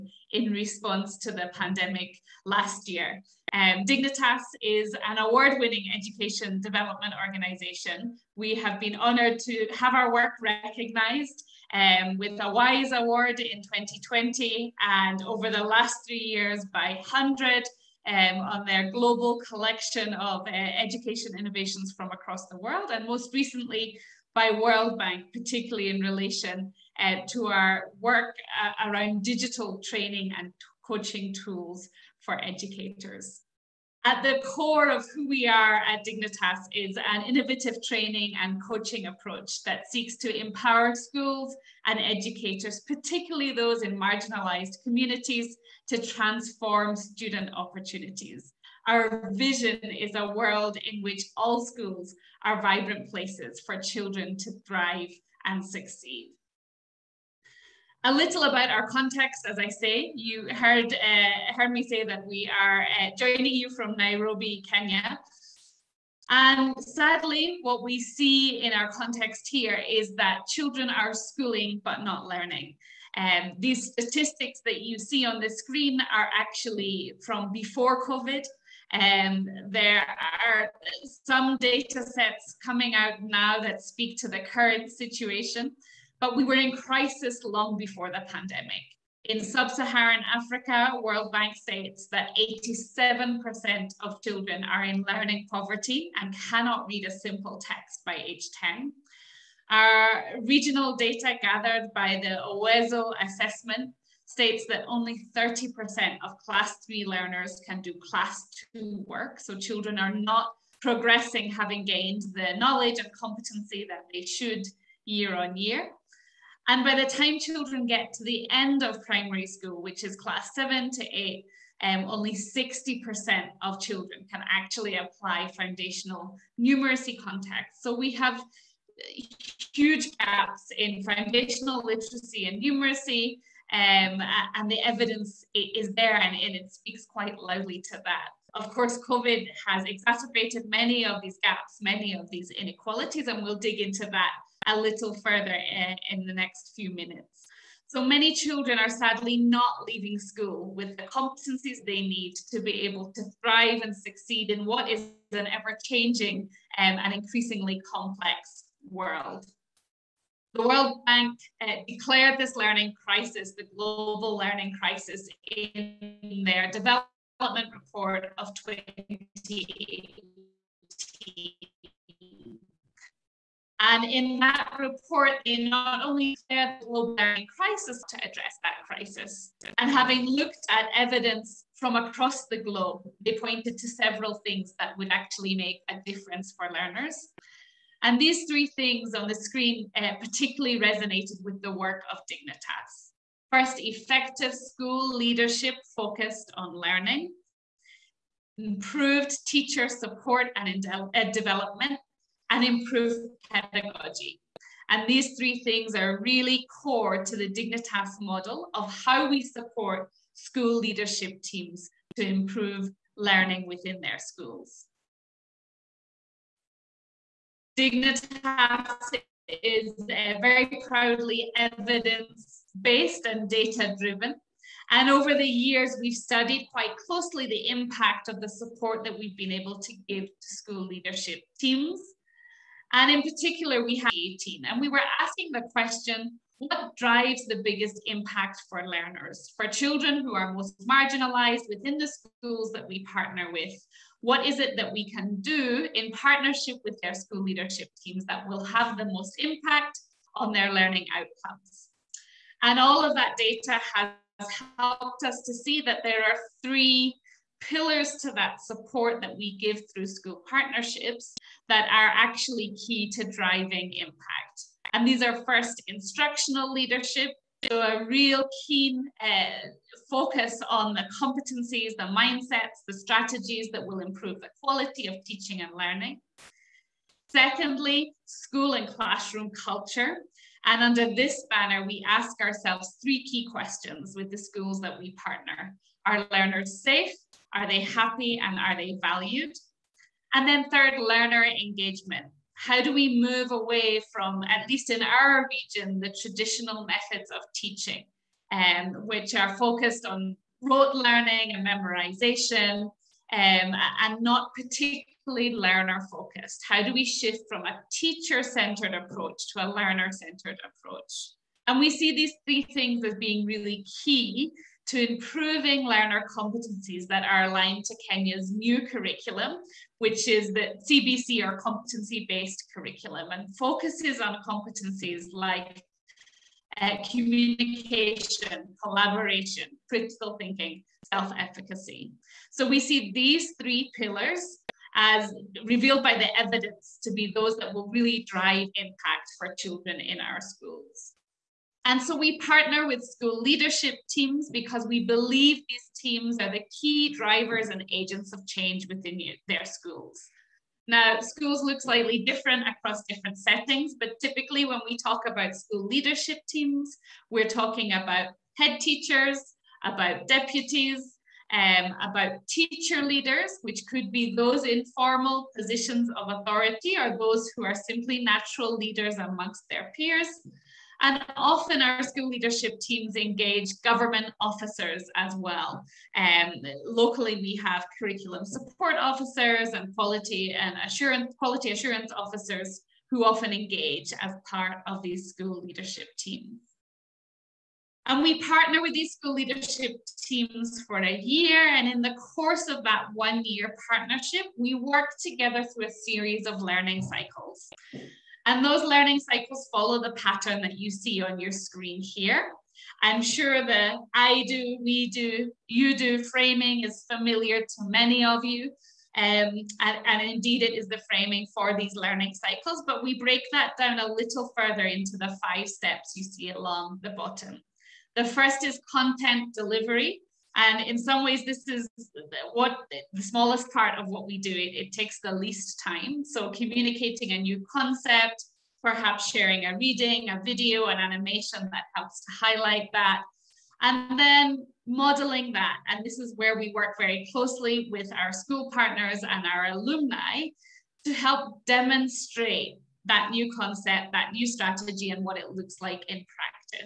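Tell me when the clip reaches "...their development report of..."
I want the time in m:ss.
2:46.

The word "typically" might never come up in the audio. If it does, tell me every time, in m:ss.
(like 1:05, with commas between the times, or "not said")
5:54.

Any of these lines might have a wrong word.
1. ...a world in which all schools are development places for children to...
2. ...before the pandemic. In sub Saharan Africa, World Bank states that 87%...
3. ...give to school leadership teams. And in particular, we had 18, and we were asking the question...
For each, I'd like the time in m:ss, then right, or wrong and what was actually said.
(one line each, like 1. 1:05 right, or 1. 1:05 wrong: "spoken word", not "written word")
1. 0:50 wrong: "vibrant", not "development"
2. 1:27 right
3. 3:50 right.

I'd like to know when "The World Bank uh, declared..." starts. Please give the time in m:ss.
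2:40.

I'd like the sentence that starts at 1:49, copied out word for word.
So children are not progressing having gained the knowledge and competency that they should year on year.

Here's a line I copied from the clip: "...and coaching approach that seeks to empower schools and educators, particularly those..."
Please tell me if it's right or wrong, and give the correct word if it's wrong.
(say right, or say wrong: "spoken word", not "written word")
right.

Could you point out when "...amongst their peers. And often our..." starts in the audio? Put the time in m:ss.
6:09.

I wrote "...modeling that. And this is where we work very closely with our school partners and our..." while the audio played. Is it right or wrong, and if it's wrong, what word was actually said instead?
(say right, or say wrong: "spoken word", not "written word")
right.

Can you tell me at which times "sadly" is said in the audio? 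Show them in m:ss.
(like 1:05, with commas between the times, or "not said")
1:06, 2:28.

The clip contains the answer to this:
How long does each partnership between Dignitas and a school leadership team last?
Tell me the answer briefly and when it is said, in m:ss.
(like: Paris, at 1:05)
A year, at 6:30.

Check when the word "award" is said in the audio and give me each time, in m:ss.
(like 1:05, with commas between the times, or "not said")
0:05, 0:12.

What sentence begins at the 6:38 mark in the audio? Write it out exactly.
And those learning cycles follow the pattern that you see on your screen here.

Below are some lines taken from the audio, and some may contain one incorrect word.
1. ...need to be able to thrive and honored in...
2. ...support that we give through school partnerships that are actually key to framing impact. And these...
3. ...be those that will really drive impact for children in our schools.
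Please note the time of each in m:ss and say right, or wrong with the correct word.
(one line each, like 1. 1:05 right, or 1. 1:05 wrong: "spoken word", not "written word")
1. 2:32 wrong: "succeed", not "honored"
2. 4:18 wrong: "driving", not "framing"
3. 5:37 right.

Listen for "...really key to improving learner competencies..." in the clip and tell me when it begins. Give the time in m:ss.
5:13.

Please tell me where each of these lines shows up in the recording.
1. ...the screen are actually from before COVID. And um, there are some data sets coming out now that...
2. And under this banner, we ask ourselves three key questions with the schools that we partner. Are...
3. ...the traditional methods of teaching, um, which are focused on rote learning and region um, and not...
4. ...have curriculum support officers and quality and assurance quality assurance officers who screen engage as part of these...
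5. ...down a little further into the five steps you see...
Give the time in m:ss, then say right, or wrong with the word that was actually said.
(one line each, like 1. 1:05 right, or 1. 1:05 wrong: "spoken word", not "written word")
1. 1:15 right
2. 4:40 right
3. 4:55 wrong: "memorization", not "region"
4. 6:17 wrong: "often", not "screen"
5. 6:53 right.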